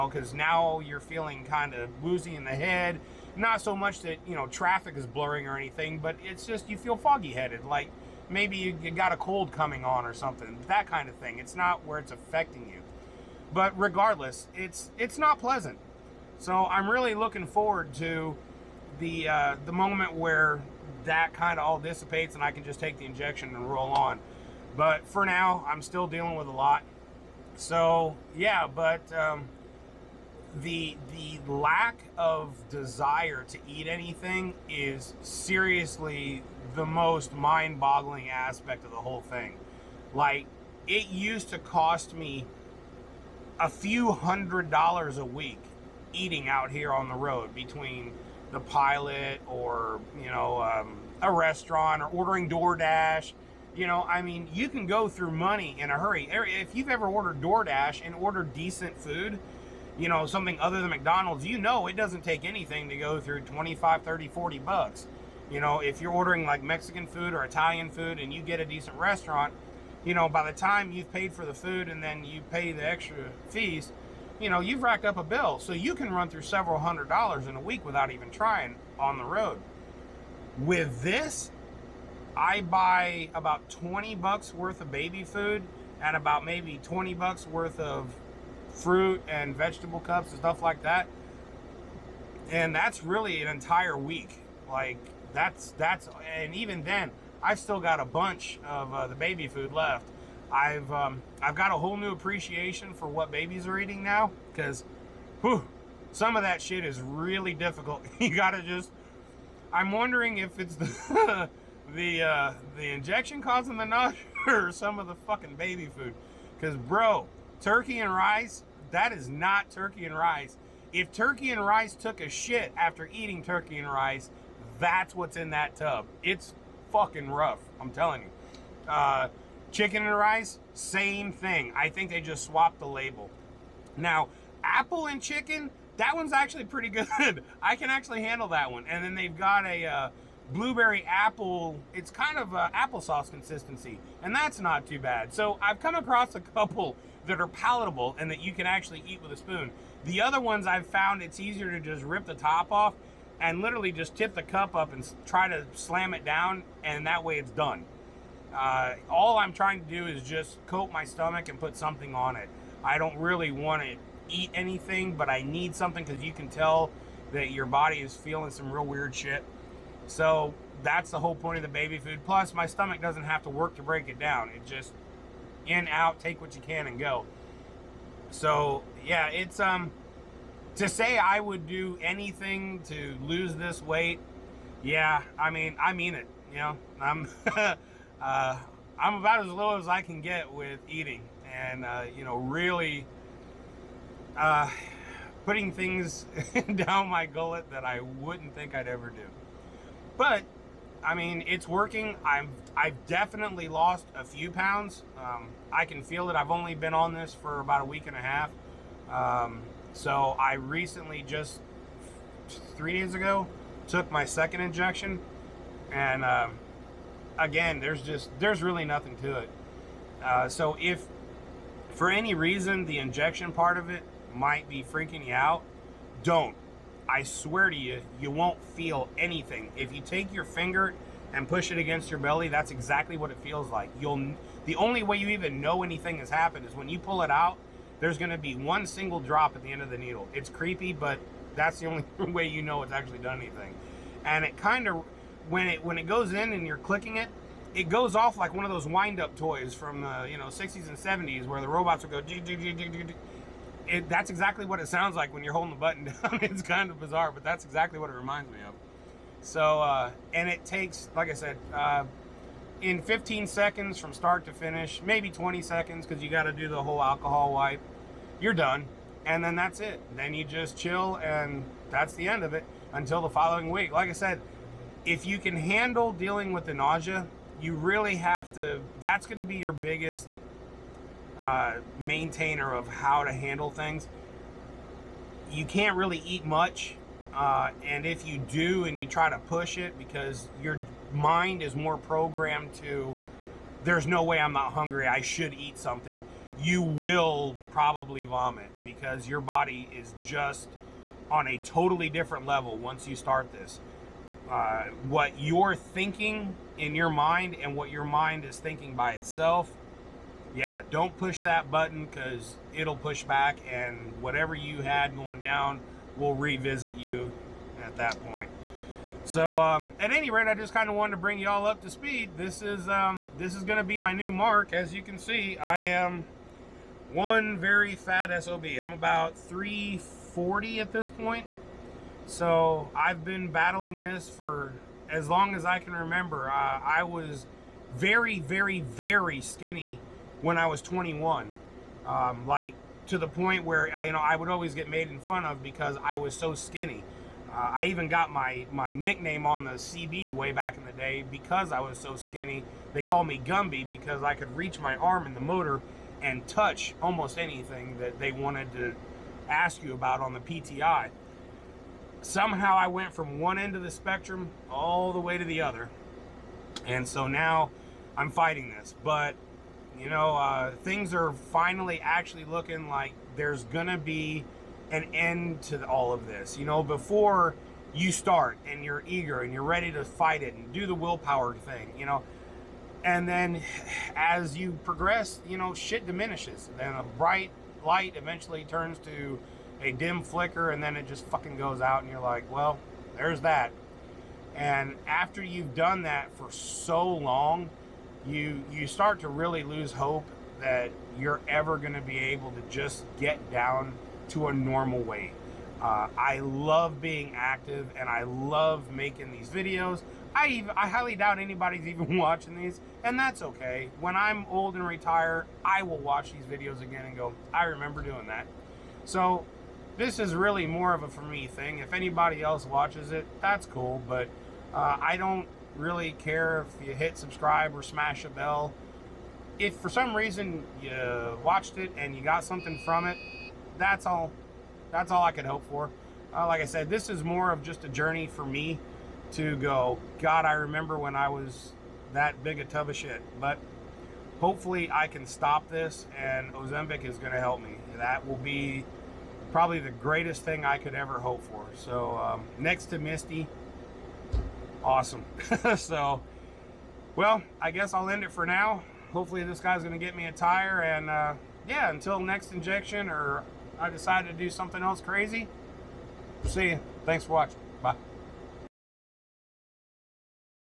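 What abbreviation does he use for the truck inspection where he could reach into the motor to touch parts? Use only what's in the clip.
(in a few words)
PTI.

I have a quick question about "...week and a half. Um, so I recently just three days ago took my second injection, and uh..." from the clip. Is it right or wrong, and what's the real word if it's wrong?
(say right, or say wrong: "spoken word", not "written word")
right.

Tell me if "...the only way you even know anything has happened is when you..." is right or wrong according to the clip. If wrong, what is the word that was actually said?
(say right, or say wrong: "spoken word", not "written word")
right.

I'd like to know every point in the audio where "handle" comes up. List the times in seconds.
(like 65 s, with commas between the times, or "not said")
138 s, 275 s, 283 s.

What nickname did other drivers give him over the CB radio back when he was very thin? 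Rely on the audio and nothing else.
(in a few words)
Gumby.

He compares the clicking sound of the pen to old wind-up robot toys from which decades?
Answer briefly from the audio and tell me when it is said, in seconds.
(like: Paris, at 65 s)
60s and 70s, at 250 s.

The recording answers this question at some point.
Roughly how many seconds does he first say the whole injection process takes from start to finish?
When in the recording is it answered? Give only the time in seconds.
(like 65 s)
263 s.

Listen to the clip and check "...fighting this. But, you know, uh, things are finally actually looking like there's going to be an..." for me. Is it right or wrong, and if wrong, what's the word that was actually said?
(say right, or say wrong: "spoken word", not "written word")
right.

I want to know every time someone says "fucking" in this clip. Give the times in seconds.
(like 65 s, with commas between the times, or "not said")
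115 s, 126 s, 391 s.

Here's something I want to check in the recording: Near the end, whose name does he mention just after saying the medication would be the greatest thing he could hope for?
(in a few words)
Misty.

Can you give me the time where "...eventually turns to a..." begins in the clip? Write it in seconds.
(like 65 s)
388 s.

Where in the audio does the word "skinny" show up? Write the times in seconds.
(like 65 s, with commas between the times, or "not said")
339 s, 346 s, 352 s.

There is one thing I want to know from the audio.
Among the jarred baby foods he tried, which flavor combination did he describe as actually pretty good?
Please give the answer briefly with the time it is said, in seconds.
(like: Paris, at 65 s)
Apple and chicken, at 134 s.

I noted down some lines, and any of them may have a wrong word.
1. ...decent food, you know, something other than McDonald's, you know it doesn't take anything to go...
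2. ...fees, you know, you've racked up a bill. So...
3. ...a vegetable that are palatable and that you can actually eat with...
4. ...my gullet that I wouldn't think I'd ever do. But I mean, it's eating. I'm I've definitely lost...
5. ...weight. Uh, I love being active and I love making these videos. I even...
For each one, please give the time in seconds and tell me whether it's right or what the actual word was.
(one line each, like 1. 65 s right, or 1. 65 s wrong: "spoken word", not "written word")
1. 58 s right
2. 73 s right
3. 146 s wrong: "couple", not "vegetable"
4. 197 s wrong: "working", not "eating"
5. 405 s right.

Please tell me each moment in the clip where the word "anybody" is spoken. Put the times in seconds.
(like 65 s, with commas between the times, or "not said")
411 s, 421 s.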